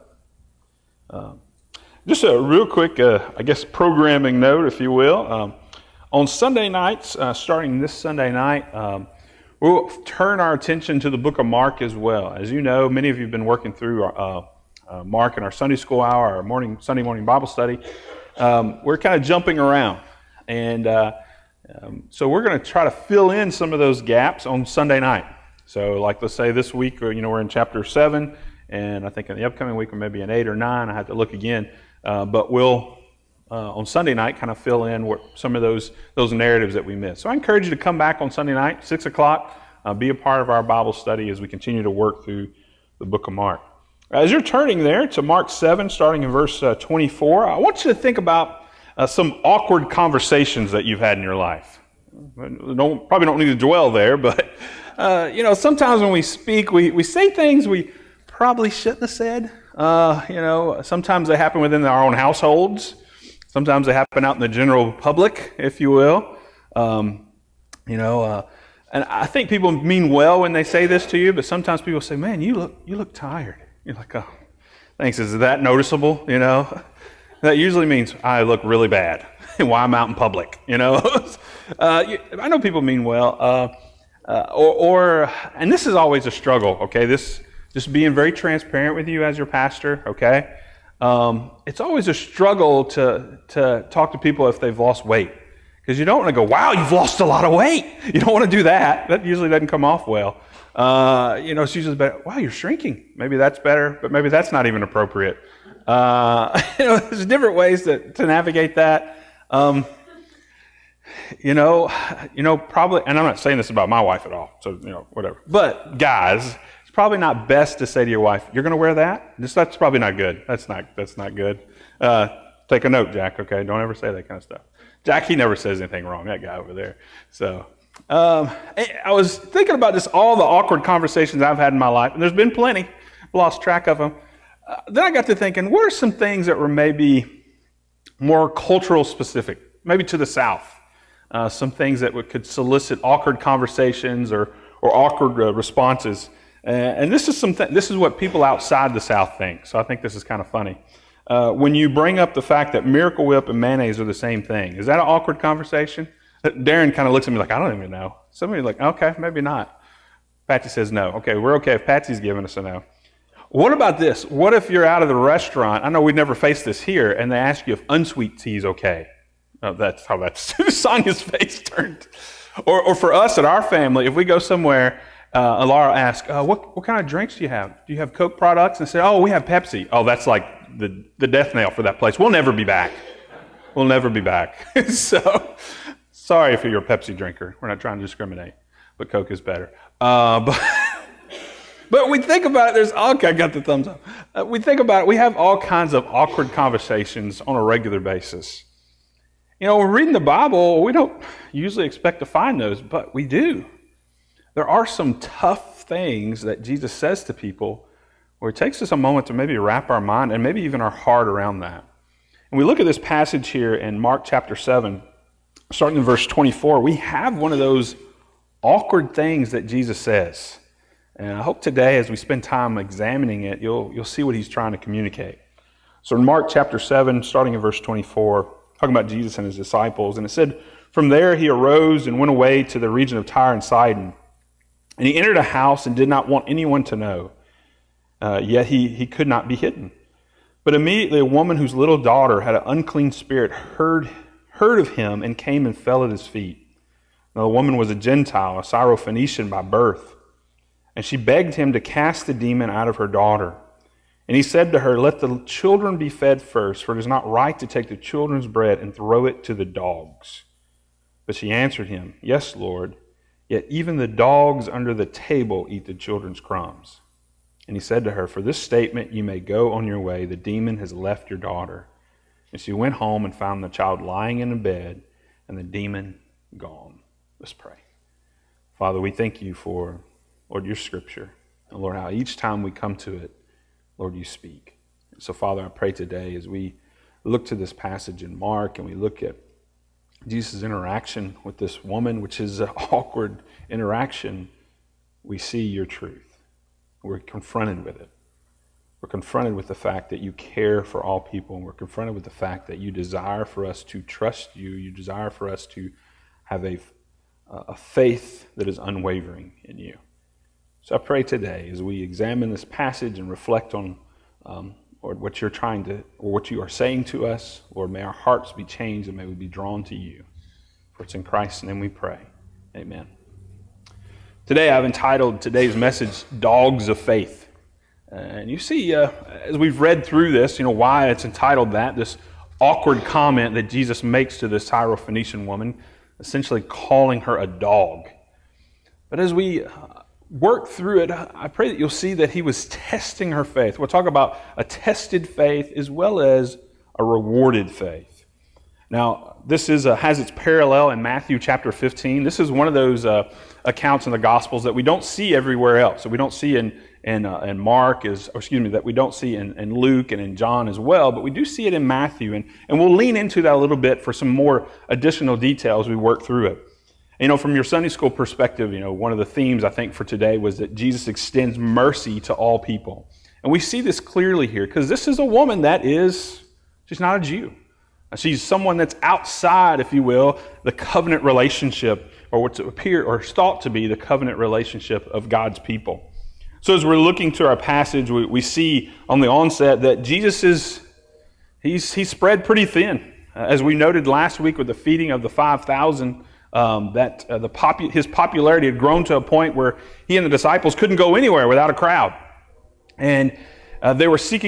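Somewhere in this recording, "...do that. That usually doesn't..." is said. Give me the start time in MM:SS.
01:38.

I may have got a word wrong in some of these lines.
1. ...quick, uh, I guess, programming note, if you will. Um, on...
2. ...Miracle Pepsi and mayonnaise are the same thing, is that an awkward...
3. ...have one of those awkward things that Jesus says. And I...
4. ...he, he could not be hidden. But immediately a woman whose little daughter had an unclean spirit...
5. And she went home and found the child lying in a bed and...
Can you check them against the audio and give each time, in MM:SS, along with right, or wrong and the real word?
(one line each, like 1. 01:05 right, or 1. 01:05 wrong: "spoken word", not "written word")
1. 00:02 right
2. 02:32 wrong: "Whip", not "Pepsi"
3. 03:36 right
4. 03:58 right
5. 04:32 right.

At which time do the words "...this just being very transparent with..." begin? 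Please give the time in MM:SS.
01:27.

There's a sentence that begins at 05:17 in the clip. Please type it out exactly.
Lord, may our hearts be changed and may we be drawn to you.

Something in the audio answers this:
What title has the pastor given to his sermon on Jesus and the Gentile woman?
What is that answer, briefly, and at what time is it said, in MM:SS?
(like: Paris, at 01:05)
Dogs of Faith, at 05:26.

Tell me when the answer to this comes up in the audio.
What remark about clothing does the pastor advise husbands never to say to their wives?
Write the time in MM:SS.
01:58.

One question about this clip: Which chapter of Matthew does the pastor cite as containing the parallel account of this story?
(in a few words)
Chapter 15.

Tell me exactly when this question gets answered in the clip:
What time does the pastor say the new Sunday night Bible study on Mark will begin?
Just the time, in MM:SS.
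00:38.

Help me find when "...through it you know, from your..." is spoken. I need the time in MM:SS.
06:06.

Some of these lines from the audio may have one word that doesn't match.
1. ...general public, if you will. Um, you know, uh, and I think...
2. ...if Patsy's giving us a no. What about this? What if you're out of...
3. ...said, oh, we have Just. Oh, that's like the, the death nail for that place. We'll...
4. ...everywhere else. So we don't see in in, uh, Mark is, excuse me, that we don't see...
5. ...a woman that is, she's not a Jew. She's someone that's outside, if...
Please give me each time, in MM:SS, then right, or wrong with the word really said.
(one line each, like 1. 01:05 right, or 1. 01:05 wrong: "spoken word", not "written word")
1. 01:04 right
2. 02:41 right
3. 02:58 wrong: "Pepsi", not "Just"
4. 05:55 right
5. 06:15 right.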